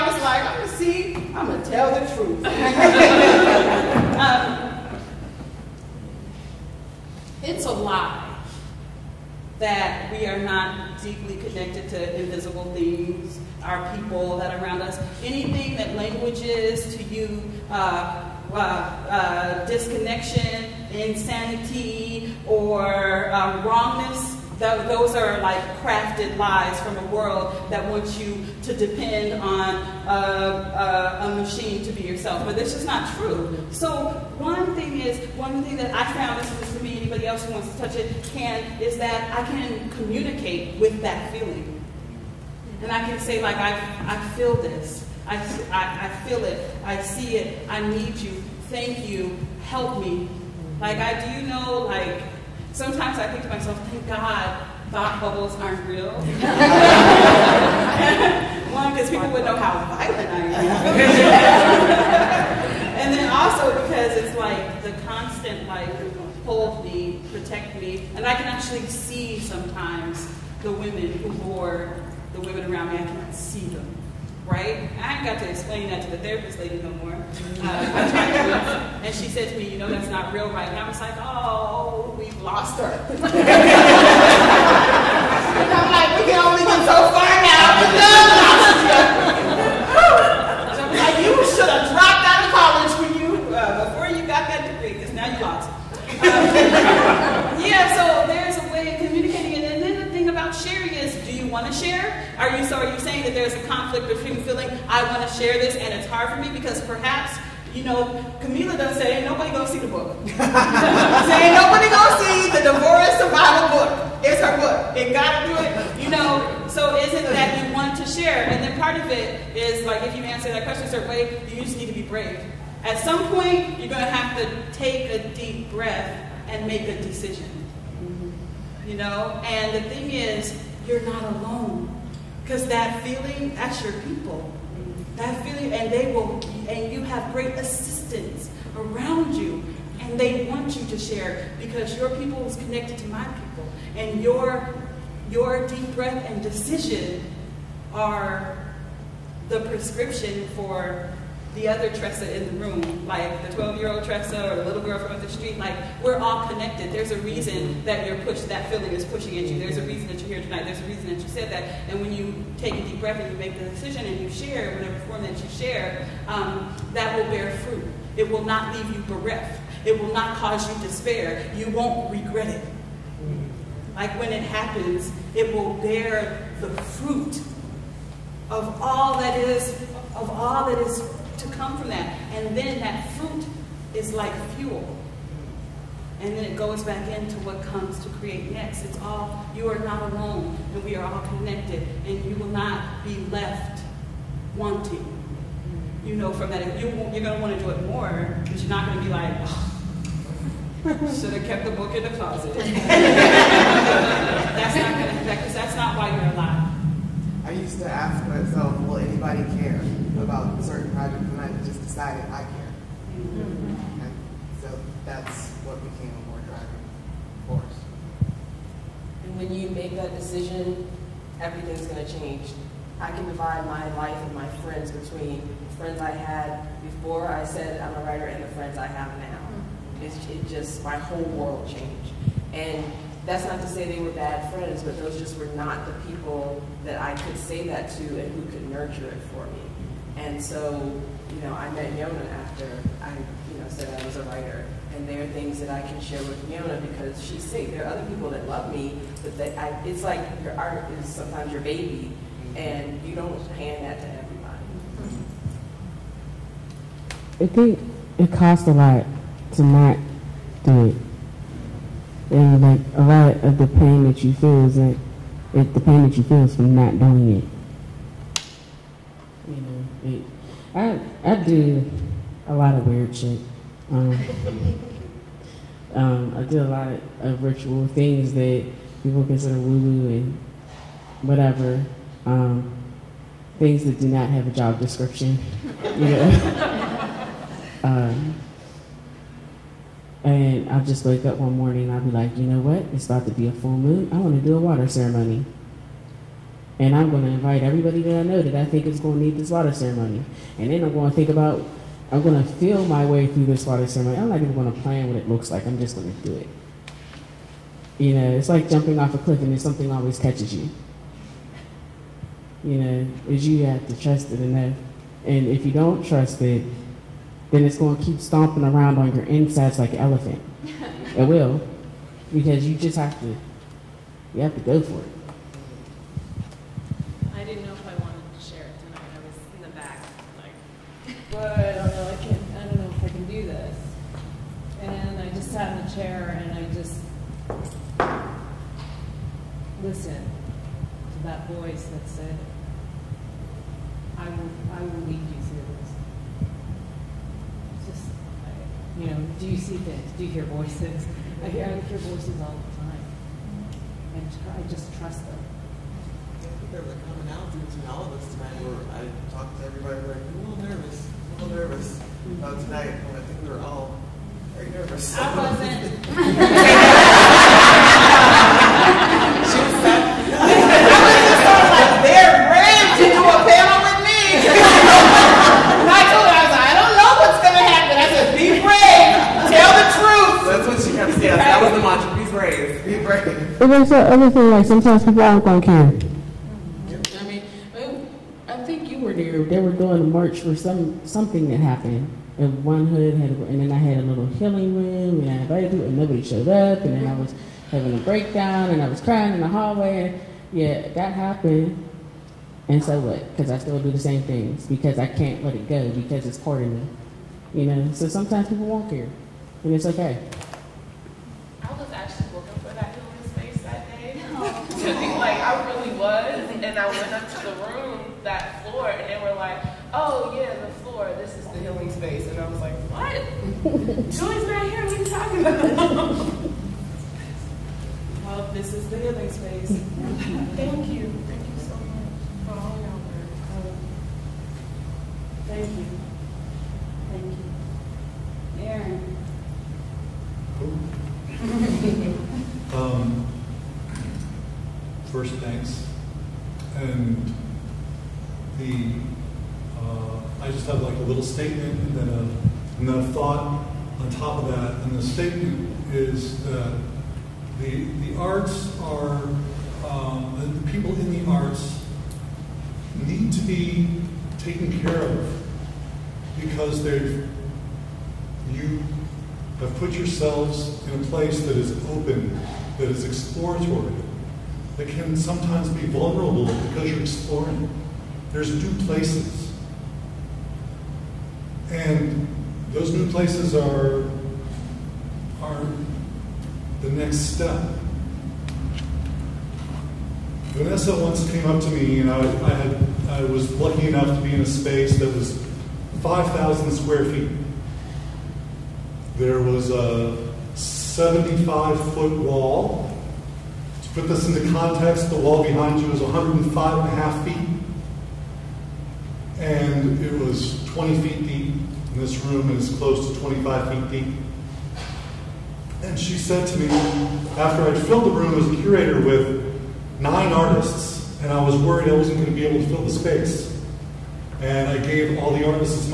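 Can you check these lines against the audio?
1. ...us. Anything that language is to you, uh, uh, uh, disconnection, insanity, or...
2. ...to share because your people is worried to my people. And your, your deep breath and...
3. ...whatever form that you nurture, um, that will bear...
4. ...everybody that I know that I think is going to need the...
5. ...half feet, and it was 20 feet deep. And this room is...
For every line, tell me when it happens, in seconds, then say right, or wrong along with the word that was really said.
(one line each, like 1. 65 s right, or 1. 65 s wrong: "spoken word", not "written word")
1. 14 s right
2. 140 s wrong: "connected", not "worried"
3. 164 s wrong: "share", not "nurture"
4. 297 s right
5. 506 s right.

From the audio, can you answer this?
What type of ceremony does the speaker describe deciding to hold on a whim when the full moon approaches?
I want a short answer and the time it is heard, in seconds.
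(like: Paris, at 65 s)
water ceremony, at 294 s.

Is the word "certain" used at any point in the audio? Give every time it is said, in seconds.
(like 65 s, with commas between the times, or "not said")
120 s, 210 s.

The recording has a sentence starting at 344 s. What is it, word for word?
I will lead you through this.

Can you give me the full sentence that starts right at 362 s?
And I think we were all very nervous.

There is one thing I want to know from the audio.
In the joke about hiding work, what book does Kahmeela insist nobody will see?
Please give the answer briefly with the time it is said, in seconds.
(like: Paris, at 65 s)
divorce survival book, at 112 s.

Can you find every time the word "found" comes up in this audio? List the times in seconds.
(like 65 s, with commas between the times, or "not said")
36 s.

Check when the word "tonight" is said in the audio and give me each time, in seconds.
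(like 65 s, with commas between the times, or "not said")
160 s, 358 s, 362 s.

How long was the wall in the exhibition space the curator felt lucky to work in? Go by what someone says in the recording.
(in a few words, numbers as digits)
75 feet.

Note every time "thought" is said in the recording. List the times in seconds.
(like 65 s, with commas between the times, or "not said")
54 s, 453 s.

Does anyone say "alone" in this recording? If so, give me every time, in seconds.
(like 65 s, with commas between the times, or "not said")
131 s, 190 s.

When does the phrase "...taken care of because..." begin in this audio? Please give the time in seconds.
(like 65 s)
464 s.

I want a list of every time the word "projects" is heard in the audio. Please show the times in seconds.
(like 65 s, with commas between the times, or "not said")
210 s.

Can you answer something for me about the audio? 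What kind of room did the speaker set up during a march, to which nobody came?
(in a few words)
healing room.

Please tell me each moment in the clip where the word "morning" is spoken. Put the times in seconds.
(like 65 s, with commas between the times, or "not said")
291 s.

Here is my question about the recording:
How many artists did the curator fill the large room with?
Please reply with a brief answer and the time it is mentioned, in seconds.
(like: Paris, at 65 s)
9, at 520 s.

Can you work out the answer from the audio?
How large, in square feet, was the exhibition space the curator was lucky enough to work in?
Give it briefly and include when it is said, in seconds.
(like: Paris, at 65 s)
5,000 square feet, at 496 s.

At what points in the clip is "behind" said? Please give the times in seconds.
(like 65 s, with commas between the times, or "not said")
505 s.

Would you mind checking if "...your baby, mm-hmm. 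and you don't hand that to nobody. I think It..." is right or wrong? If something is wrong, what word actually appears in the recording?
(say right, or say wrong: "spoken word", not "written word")
wrong: "everybody", not "nobody".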